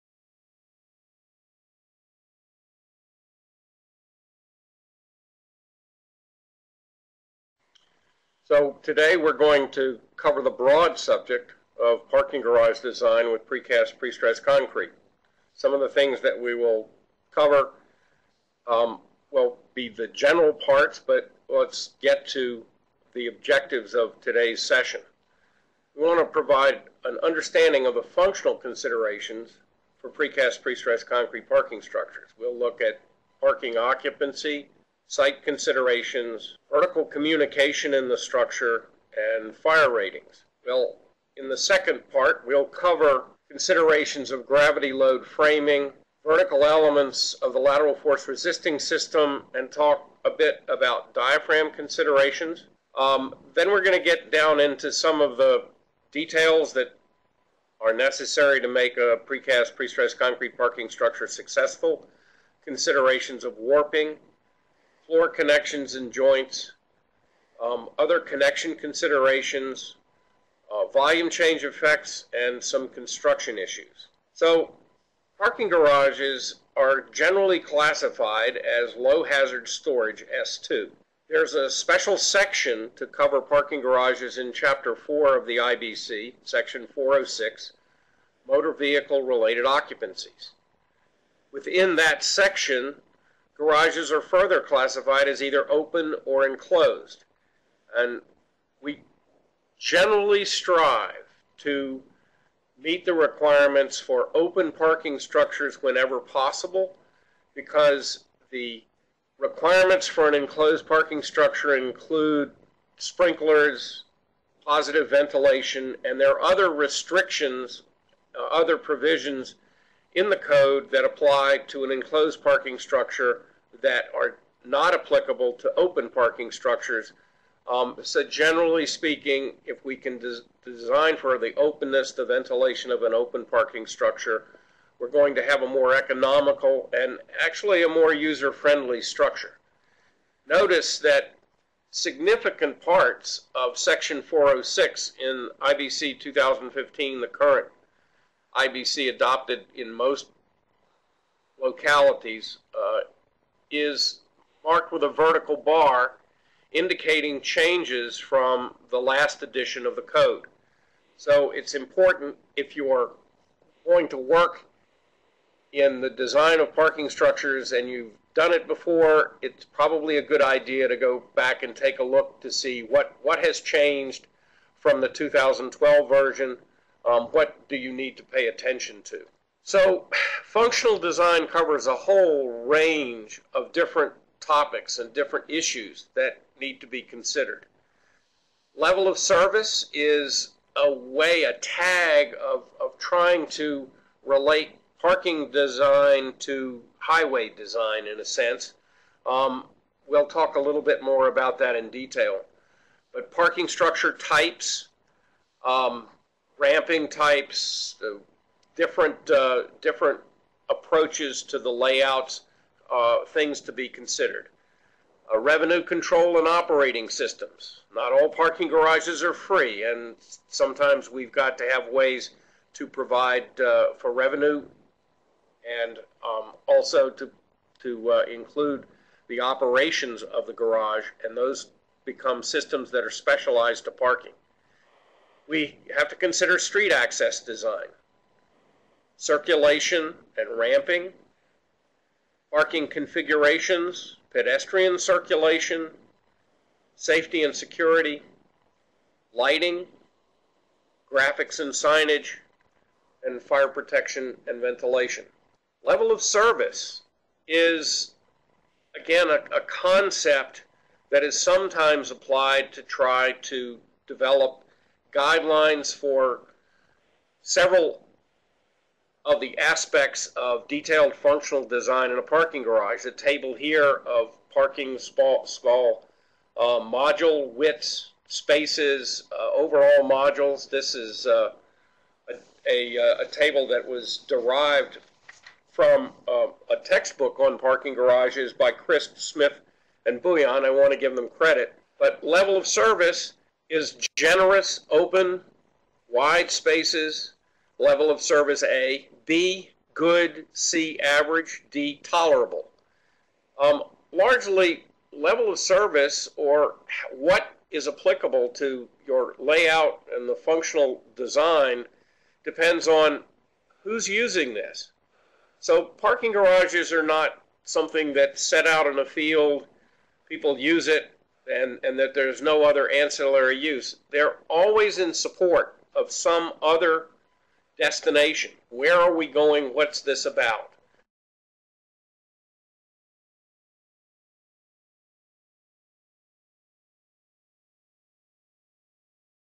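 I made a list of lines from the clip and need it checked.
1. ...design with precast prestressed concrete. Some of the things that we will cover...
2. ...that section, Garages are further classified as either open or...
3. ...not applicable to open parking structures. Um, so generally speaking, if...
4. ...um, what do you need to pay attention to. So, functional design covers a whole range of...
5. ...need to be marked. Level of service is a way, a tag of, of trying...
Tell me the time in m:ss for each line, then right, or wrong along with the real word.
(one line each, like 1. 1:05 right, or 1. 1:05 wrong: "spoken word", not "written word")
1. 0:12 right
2. 1:31 right
3. 2:04 right
4. 2:57 right
5. 3:06 wrong: "considered", not "marked".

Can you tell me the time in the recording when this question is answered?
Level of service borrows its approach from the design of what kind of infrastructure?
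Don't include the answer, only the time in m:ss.
3:16.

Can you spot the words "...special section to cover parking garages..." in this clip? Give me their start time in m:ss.
1:21.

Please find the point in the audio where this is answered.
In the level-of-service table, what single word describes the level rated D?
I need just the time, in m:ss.
5:02.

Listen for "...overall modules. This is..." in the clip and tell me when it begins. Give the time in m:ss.
4:39.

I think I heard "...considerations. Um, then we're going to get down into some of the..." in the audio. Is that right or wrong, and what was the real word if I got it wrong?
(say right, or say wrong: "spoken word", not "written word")
right.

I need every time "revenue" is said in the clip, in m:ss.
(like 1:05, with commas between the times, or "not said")
3:35, 3:44.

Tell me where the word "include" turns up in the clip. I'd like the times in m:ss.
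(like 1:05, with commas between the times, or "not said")
1:51, 3:48.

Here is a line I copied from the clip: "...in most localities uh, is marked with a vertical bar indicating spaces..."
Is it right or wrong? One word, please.
wrong.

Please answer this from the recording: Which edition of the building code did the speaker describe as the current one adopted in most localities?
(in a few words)
IBC 2015.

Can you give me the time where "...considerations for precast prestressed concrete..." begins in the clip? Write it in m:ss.
0:28.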